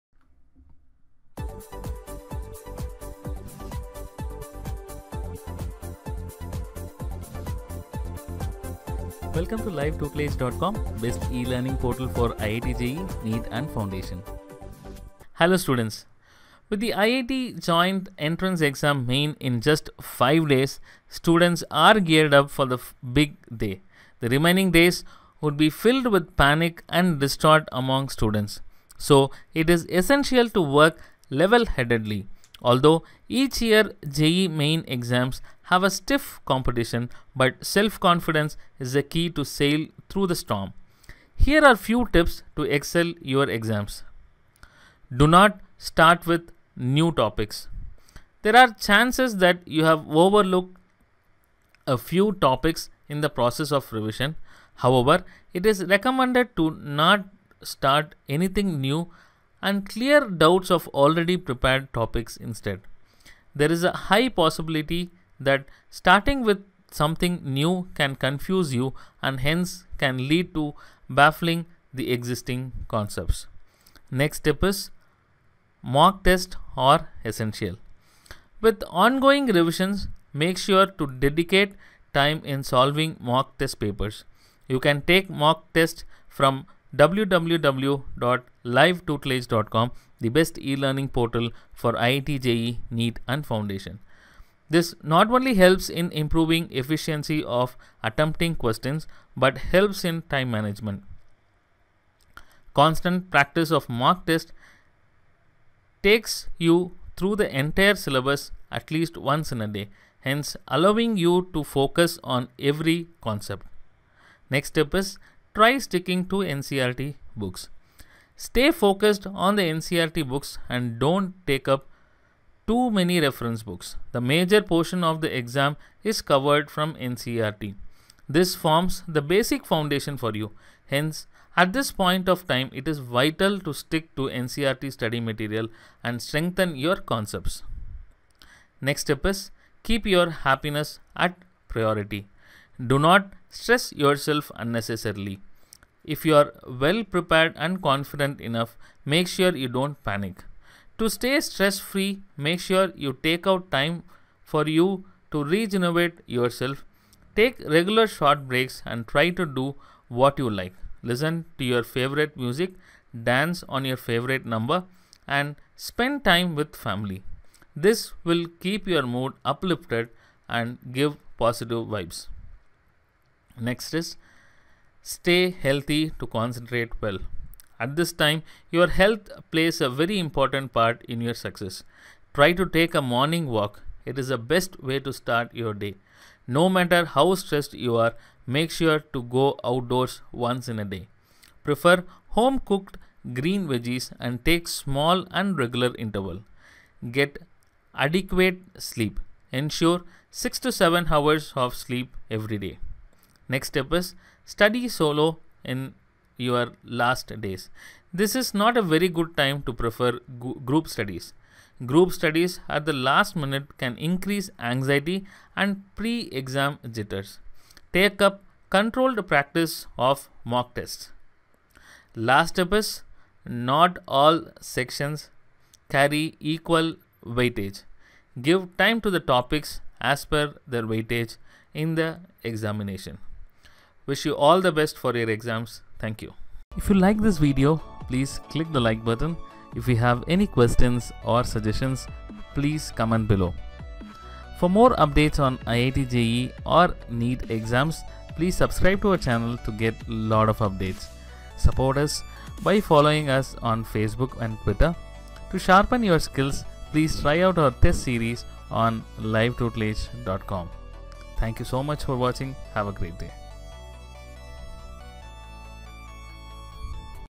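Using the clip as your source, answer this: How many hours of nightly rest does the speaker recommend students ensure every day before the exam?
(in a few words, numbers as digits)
6 to 7.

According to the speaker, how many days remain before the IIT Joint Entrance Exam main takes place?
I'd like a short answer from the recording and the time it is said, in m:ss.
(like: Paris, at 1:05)
5, at 0:20.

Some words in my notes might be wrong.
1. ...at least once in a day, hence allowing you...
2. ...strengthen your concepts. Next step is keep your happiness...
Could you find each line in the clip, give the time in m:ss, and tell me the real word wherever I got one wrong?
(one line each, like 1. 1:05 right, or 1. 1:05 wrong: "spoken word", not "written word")
1. 1:48 right
2. 2:16 right.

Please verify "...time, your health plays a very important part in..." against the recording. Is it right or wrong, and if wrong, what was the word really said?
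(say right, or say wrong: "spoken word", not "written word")
right.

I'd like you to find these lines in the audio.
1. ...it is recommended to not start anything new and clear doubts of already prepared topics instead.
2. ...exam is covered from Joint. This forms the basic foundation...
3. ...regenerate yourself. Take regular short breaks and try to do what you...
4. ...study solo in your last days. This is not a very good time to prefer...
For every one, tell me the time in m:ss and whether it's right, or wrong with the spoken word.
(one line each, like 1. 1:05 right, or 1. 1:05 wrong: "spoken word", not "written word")
1. 0:55 right
2. 2:05 wrong: "NCERT", not "Joint"
3. 2:35 right
4. 3:24 right.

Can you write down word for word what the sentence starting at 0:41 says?
Here are few tips to excel your exams.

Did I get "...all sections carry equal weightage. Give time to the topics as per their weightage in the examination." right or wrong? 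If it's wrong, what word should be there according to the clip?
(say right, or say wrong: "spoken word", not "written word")
right.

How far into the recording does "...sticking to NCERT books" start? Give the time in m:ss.
1:55.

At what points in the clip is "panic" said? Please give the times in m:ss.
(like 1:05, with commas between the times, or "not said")
0:26, 2:30.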